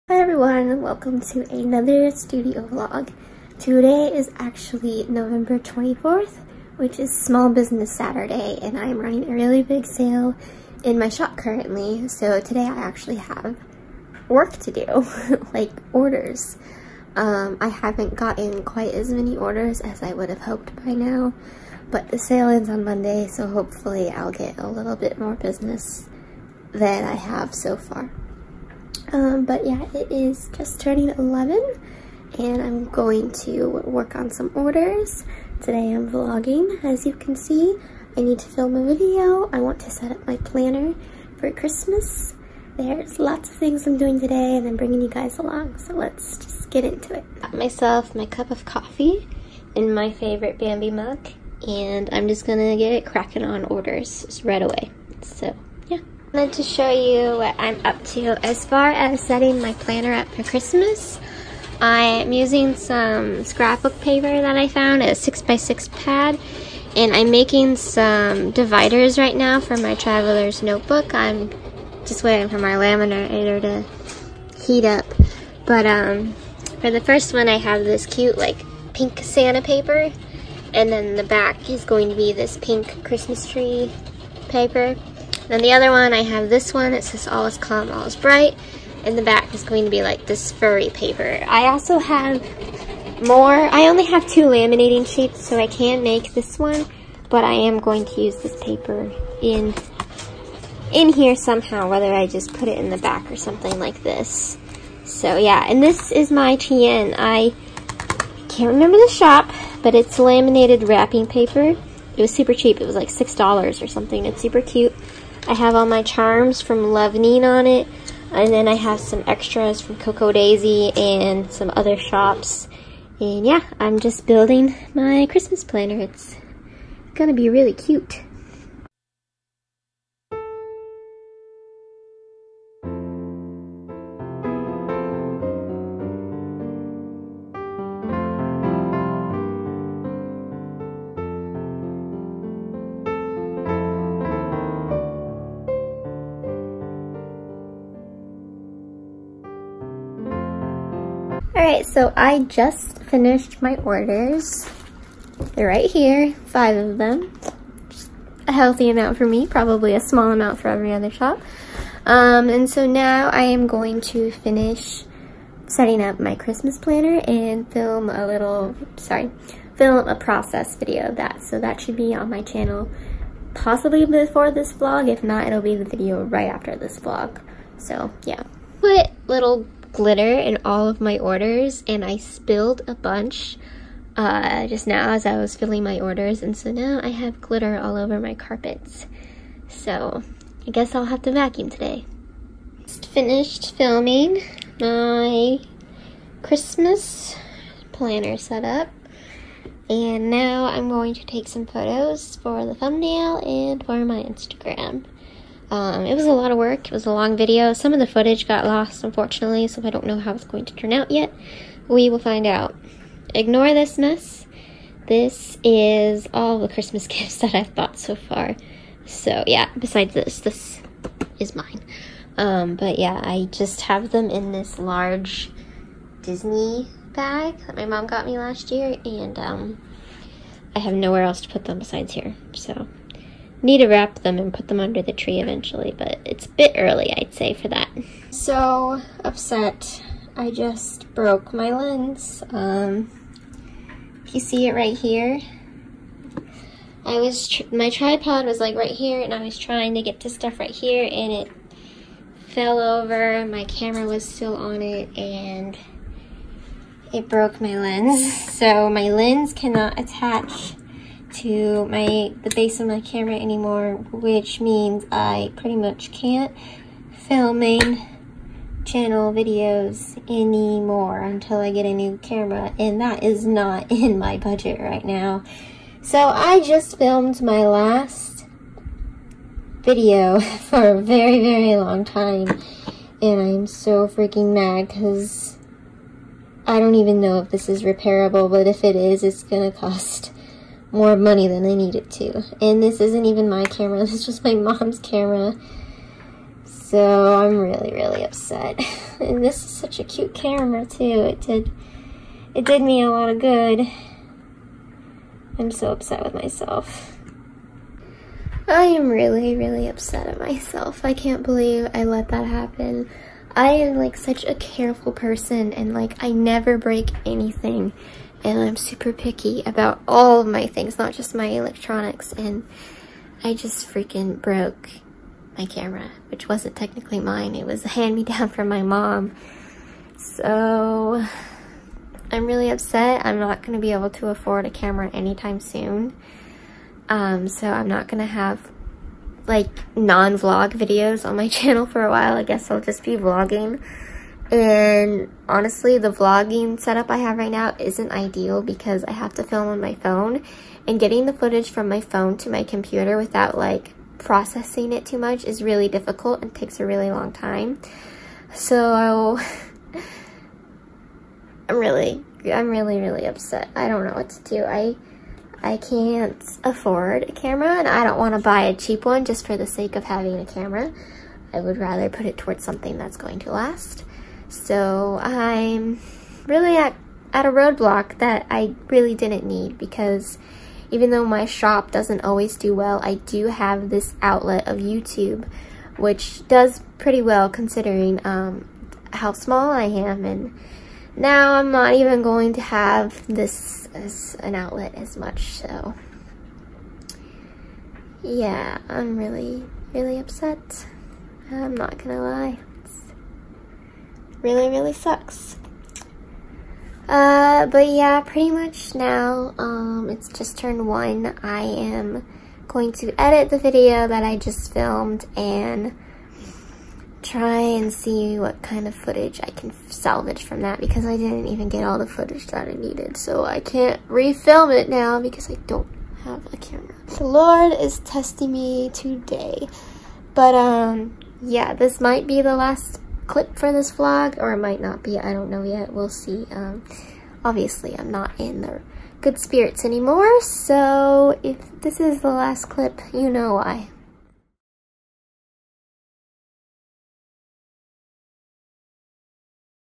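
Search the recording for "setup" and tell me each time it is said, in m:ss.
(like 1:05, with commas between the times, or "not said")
3:18, 5:46.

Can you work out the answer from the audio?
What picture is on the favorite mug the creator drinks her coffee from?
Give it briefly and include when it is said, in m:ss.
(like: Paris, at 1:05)
Bambi, at 0:50.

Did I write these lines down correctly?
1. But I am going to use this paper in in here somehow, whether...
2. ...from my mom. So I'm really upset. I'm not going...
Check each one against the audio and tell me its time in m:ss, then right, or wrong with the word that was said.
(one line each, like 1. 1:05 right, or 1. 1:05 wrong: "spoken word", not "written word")
1. 1:37 right
2. 5:28 right.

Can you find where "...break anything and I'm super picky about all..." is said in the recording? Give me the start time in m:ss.
5:16.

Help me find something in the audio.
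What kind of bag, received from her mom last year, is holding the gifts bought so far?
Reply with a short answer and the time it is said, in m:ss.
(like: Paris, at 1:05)
Large Disney bag, at 3:44.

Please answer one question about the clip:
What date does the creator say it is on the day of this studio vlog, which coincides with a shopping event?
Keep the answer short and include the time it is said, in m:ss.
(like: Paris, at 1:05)
November 24th, at 0:05.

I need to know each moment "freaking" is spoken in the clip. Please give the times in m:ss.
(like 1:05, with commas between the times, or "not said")
4:44, 5:23.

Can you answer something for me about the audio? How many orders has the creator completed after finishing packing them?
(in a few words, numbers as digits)
5.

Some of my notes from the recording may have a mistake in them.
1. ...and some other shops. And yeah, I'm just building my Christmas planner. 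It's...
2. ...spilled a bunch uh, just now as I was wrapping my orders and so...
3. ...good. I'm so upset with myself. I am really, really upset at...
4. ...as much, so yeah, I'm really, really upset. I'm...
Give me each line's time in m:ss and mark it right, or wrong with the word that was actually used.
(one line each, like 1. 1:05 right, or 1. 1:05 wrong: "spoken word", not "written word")
1. 2:00 right
2. 3:02 wrong: "filling", not "wrapping"
3. 5:03 right
4. 6:34 right.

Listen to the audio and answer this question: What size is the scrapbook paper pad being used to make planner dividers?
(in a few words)
6x6.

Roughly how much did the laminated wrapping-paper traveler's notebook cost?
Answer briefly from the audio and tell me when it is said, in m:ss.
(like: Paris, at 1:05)
$6, at 1:53.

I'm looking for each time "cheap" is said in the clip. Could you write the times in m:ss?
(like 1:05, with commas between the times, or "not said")
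1:52, 6:08.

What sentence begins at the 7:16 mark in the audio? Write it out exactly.
Um, obviously, I'm not in the good spirits anymore, so if this is the last clip, you know why.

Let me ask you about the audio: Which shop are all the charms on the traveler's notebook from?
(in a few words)
Levenin.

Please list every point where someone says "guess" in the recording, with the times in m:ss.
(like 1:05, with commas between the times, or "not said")
3:10, 5:42.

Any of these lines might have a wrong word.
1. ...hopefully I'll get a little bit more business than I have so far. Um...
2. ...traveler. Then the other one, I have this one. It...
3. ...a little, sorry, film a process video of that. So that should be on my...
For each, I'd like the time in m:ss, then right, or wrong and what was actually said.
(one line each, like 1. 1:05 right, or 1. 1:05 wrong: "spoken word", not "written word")
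1. 0:23 right
2. 1:24 wrong: "paper", not "traveler"
3. 2:48 right.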